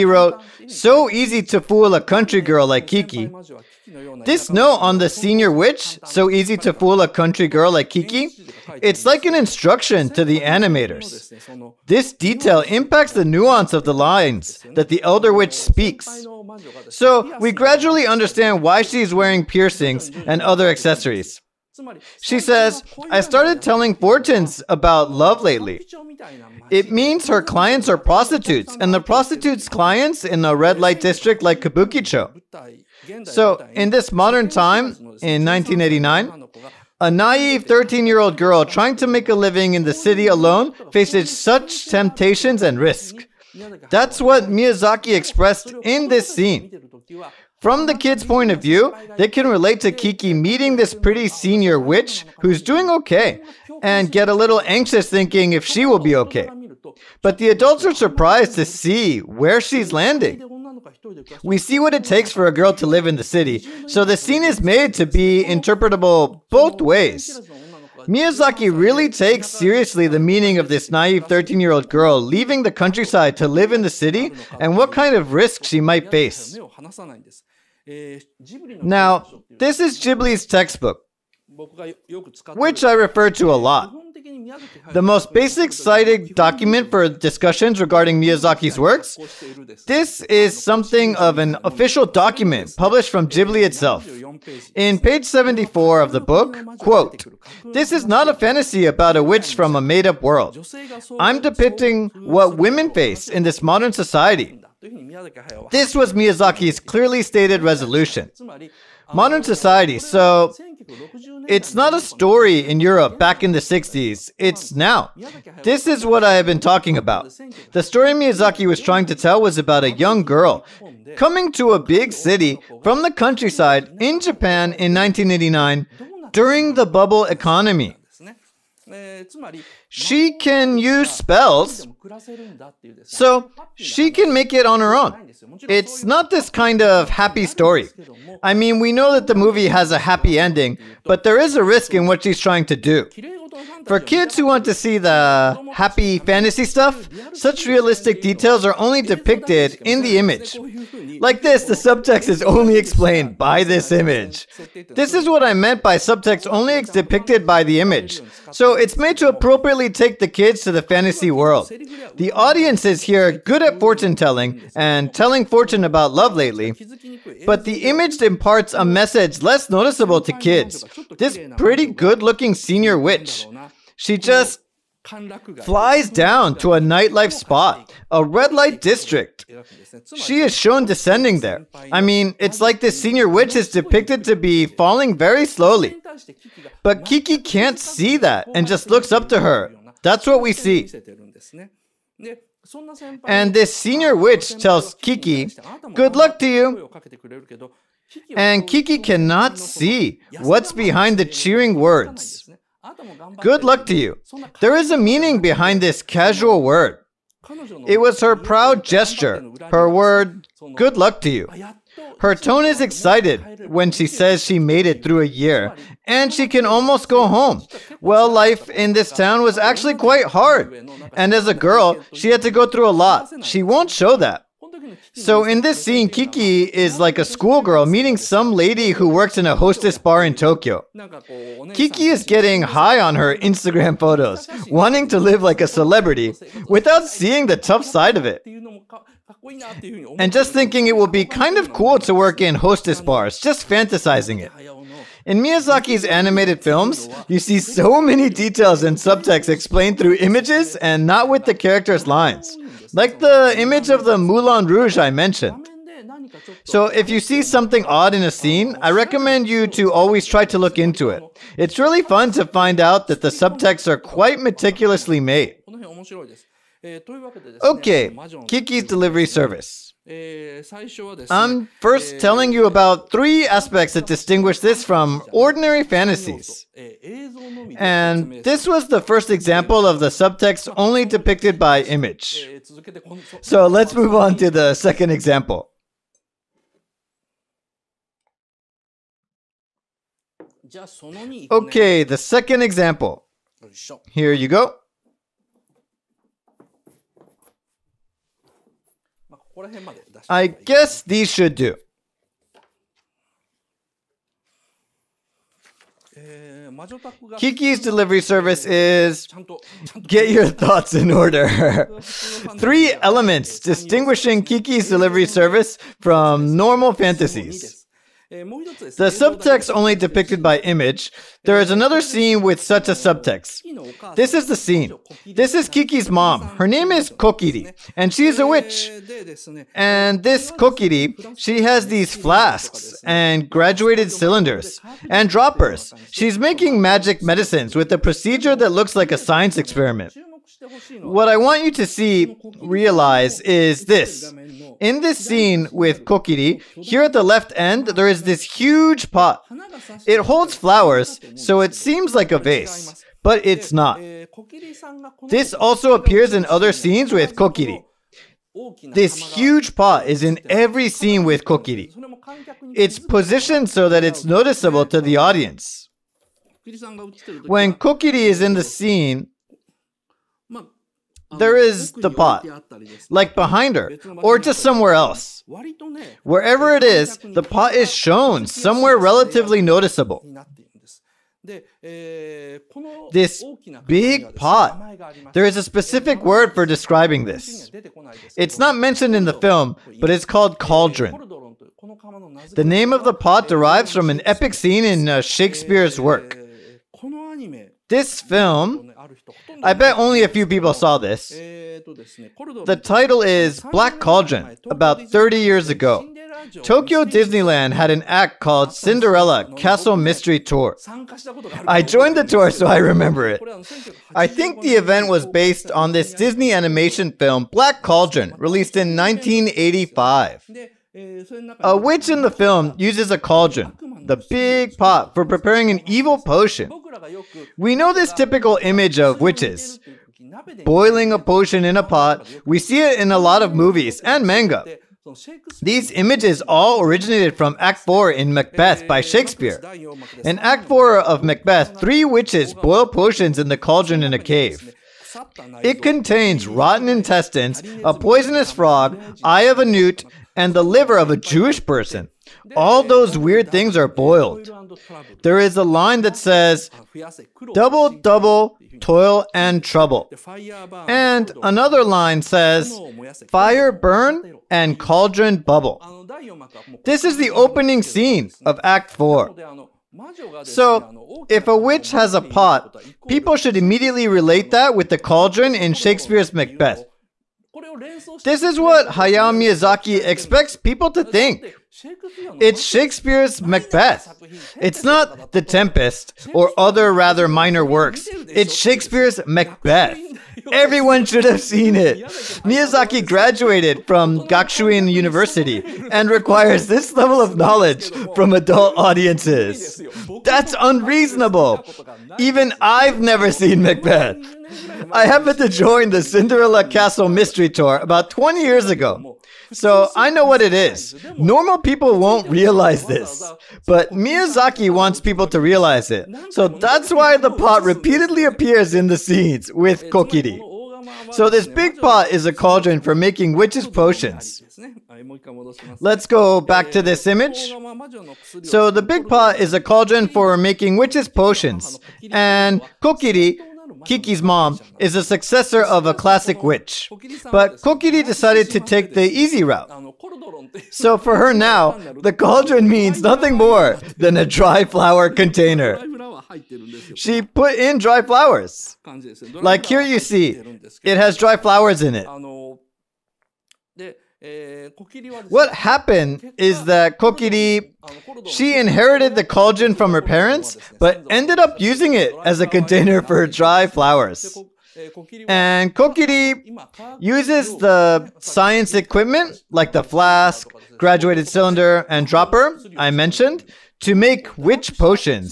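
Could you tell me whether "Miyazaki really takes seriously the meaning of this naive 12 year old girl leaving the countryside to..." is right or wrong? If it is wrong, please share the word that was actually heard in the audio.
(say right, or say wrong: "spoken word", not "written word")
wrong: "13", not "12".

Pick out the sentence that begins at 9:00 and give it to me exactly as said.
So for her now, the cauldron means nothing more than a dry flower container.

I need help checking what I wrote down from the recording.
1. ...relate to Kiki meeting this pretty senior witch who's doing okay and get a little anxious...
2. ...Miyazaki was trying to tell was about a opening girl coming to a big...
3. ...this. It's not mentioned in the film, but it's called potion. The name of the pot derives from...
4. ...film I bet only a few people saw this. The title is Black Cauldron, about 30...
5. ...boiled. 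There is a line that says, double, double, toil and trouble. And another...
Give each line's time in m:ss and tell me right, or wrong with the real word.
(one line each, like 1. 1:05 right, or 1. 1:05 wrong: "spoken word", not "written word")
1. 0:49 right
2. 1:58 wrong: "young", not "opening"
3. 6:27 wrong: "cauldron", not "potion"
4. 6:38 right
5. 7:33 right.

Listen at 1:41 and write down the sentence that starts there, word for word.
I'm depicting what women face in this modern society.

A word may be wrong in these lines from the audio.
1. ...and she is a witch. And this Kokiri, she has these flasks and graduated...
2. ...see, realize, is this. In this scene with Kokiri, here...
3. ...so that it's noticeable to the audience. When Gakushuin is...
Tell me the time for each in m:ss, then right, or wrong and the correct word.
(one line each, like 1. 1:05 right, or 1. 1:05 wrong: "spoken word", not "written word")
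1. 5:27 right
2. 5:41 right
3. 6:03 wrong: "Kokiri", not "Gakushuin".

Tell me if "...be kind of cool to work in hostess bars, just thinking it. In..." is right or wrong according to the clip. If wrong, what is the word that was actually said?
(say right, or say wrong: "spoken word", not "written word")
wrong: "fantasizing", not "thinking".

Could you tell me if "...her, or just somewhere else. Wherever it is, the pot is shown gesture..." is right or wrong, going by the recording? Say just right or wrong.
wrong.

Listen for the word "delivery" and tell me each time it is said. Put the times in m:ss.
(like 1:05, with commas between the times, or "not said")
4:28, 5:07, 5:14.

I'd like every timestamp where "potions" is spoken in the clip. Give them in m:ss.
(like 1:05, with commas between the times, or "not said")
7:06, 7:11, 7:22, 8:43, 8:51, 9:34.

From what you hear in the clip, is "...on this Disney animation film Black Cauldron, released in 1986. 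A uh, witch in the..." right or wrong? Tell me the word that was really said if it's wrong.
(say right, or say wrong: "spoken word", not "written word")
wrong: "1985", not "1986".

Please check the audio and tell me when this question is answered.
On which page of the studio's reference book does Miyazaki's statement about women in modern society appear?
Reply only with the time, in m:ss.
1:34.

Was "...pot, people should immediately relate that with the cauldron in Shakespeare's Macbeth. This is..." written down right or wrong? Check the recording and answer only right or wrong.
right.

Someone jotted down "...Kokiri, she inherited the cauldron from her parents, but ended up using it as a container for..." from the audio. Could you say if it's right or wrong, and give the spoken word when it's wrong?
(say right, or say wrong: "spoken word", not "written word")
right.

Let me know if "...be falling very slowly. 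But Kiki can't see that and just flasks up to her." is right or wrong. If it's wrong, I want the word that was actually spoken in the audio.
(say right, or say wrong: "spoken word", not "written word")
wrong: "looks", not "flasks".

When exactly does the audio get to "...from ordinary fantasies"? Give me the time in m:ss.
4:34.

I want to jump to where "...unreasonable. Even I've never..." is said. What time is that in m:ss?
8:20.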